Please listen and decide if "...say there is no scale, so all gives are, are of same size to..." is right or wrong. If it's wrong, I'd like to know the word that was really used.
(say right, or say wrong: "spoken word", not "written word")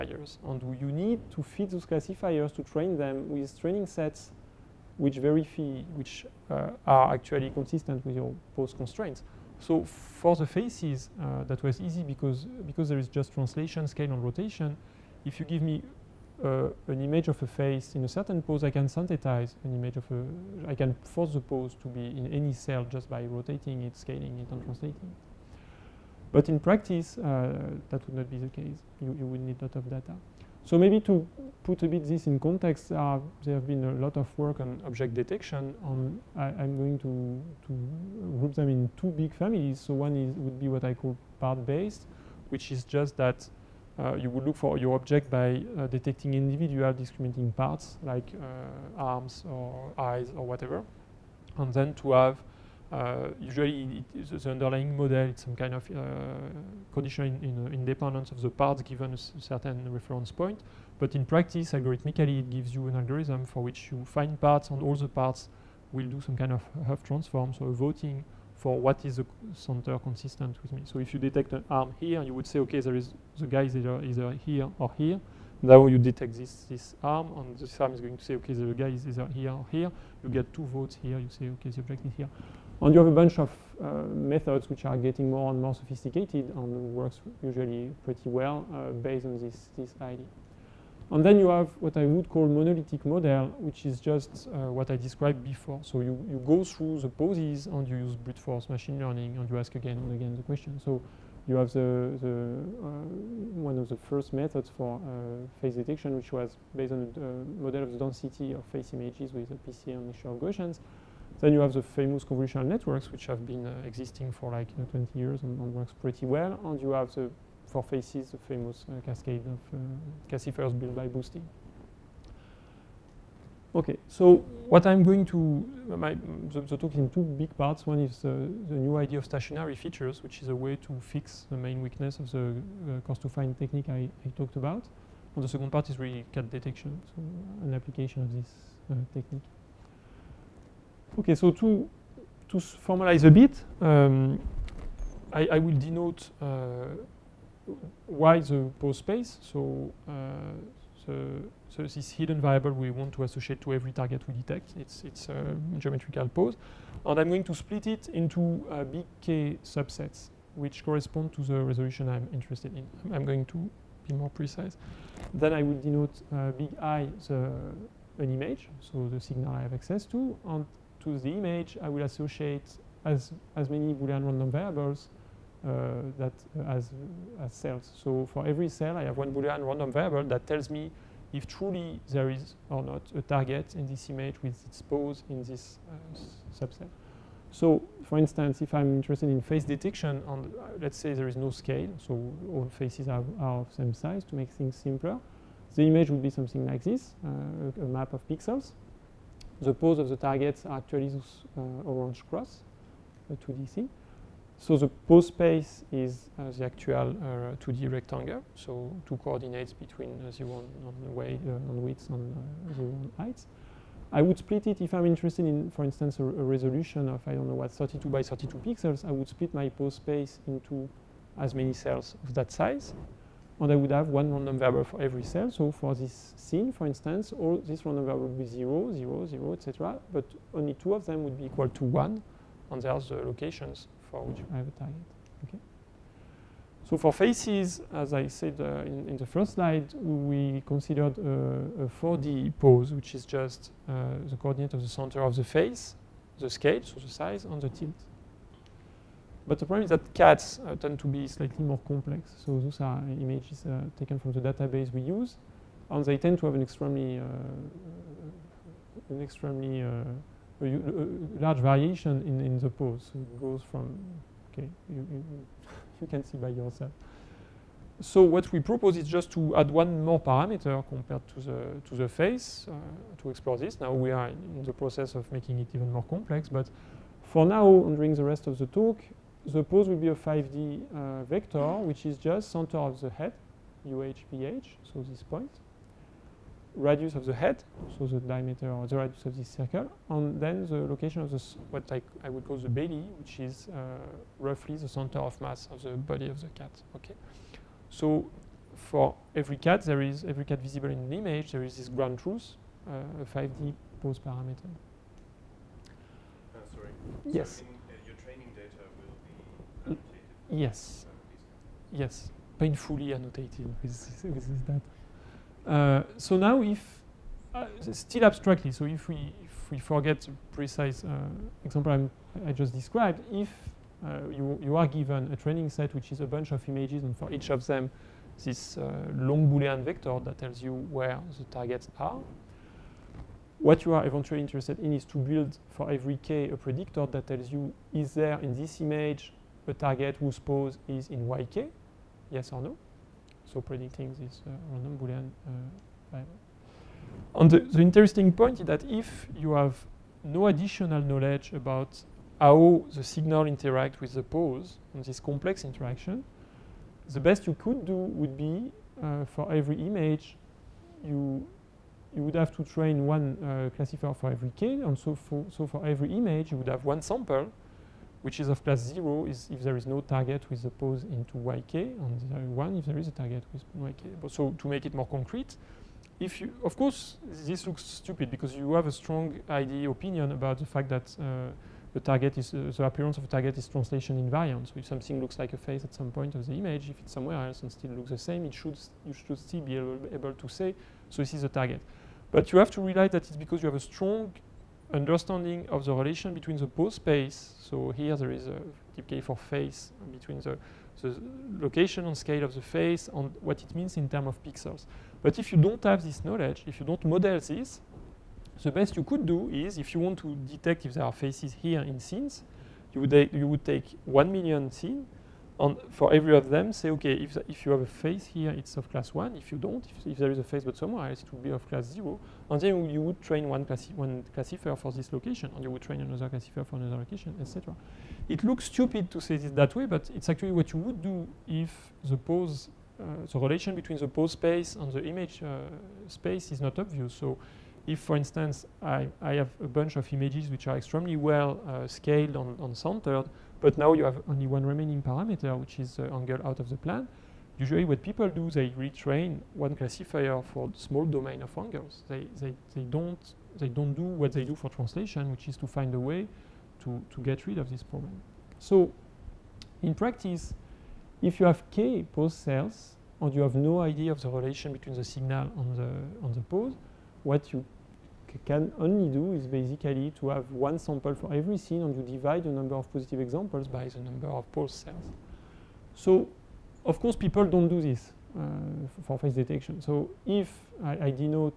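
wrong: "faces", not "gives".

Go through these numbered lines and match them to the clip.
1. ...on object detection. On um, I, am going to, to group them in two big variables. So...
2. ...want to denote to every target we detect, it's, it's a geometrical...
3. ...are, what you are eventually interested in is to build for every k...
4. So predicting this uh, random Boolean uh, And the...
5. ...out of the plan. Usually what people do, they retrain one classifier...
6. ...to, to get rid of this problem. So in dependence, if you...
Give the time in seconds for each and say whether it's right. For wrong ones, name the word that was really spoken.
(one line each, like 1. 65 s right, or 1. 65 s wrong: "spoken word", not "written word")
1. 34 s wrong: "families", not "variables"
2. 152 s wrong: "associate", not "denote"
3. 331 s right
4. 343 s right
5. 446 s right
6. 456 s wrong: "practice", not "dependence".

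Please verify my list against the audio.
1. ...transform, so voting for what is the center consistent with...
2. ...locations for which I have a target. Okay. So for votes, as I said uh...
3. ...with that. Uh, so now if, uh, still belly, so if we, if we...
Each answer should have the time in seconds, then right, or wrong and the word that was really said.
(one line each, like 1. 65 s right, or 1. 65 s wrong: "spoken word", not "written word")
1. 67 s right
2. 233 s wrong: "faces", not "votes"
3. 314 s wrong: "abstractly", not "belly".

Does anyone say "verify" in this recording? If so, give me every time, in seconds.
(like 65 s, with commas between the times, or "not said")
5 s.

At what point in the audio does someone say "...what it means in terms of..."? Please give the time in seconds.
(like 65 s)
403 s.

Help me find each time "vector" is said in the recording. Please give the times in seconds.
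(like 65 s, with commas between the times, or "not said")
281 s, 329 s.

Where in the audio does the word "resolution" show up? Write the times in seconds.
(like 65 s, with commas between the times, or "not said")
161 s, 216 s.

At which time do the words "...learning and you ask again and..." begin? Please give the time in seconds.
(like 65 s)
98 s.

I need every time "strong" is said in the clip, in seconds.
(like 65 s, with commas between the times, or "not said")
378 s, 393 s.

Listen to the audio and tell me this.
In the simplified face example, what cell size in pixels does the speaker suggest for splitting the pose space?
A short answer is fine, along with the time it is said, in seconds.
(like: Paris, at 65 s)
32 by 32, at 217 s.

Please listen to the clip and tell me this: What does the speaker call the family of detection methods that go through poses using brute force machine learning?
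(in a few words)
monolithic model.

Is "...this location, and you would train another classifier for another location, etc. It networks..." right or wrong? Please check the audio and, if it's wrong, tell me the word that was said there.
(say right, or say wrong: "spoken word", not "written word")
wrong: "looks", not "networks".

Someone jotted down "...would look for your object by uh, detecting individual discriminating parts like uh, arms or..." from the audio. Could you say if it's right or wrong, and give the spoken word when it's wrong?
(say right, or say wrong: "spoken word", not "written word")
right.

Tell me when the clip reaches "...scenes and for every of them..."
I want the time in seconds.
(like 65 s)
414 s.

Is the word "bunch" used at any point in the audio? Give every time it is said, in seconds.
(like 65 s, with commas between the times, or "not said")
83 s, 326 s, 439 s.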